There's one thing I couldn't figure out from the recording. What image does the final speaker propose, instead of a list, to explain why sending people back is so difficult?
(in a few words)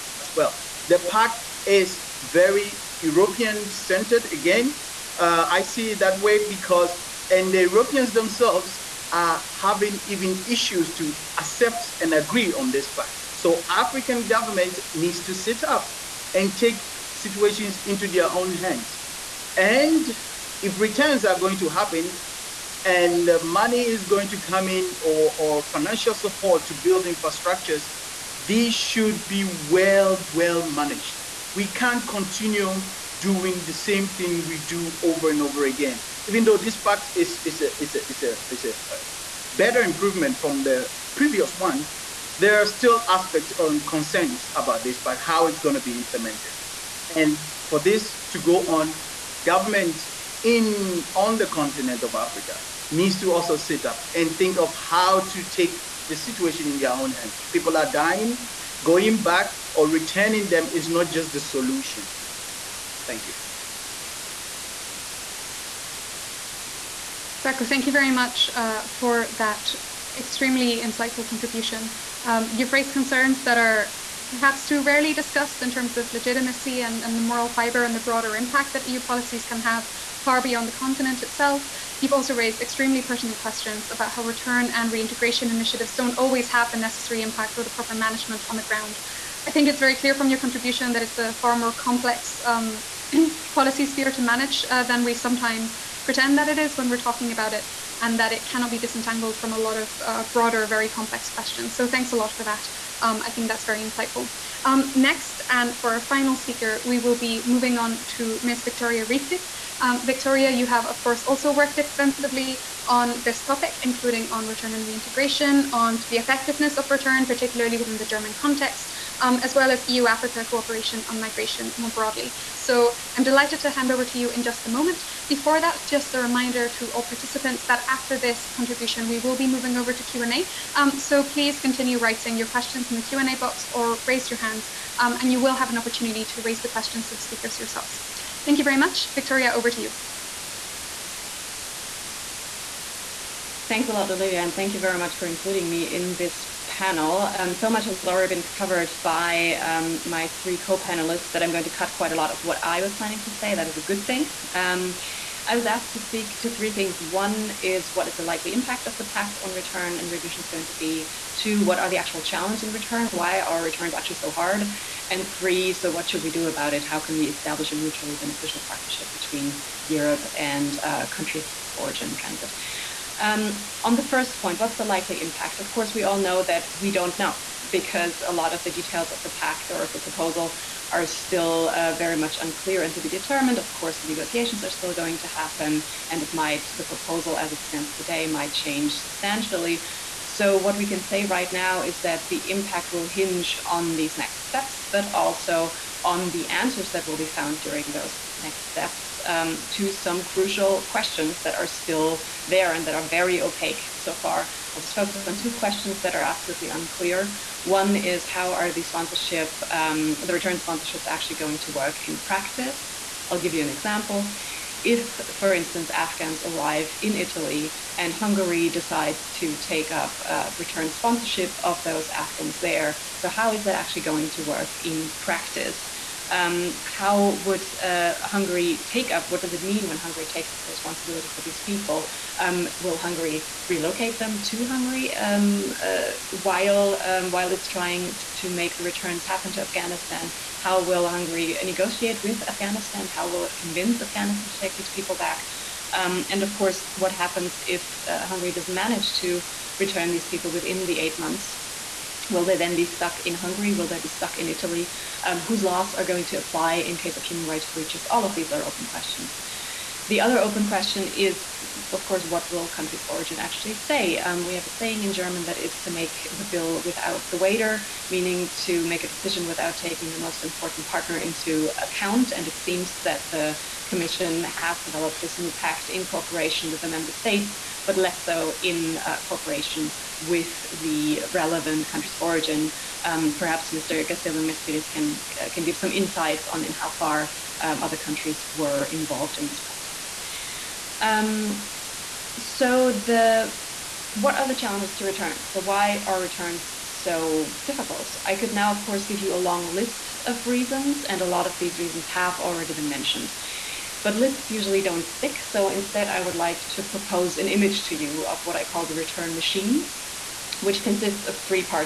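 the return machine.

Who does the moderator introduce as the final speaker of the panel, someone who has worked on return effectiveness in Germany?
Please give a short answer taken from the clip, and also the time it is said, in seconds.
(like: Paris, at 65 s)
Victoria Rietic, at 108 s.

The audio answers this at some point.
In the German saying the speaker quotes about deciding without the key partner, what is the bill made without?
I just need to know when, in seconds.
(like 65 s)
267 s.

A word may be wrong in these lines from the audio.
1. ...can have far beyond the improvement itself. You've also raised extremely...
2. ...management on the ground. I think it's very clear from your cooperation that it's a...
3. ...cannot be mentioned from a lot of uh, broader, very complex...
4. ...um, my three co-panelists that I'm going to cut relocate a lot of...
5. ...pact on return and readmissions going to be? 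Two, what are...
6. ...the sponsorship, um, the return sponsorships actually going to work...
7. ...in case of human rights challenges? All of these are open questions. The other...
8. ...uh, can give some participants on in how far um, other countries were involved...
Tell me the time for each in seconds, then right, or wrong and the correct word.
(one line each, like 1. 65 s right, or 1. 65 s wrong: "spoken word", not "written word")
1. 79 s wrong: "continent", not "improvement"
2. 87 s wrong: "contribution", not "cooperation"
3. 98 s wrong: "disentangled", not "mentioned"
4. 149 s wrong: "quite", not "relocate"
5. 159 s right
6. 208 s right
7. 256 s wrong: "breaches", not "challenges"
8. 285 s wrong: "insights", not "participants".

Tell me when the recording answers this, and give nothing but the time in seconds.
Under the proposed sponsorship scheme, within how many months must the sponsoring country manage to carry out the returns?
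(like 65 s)
250 s.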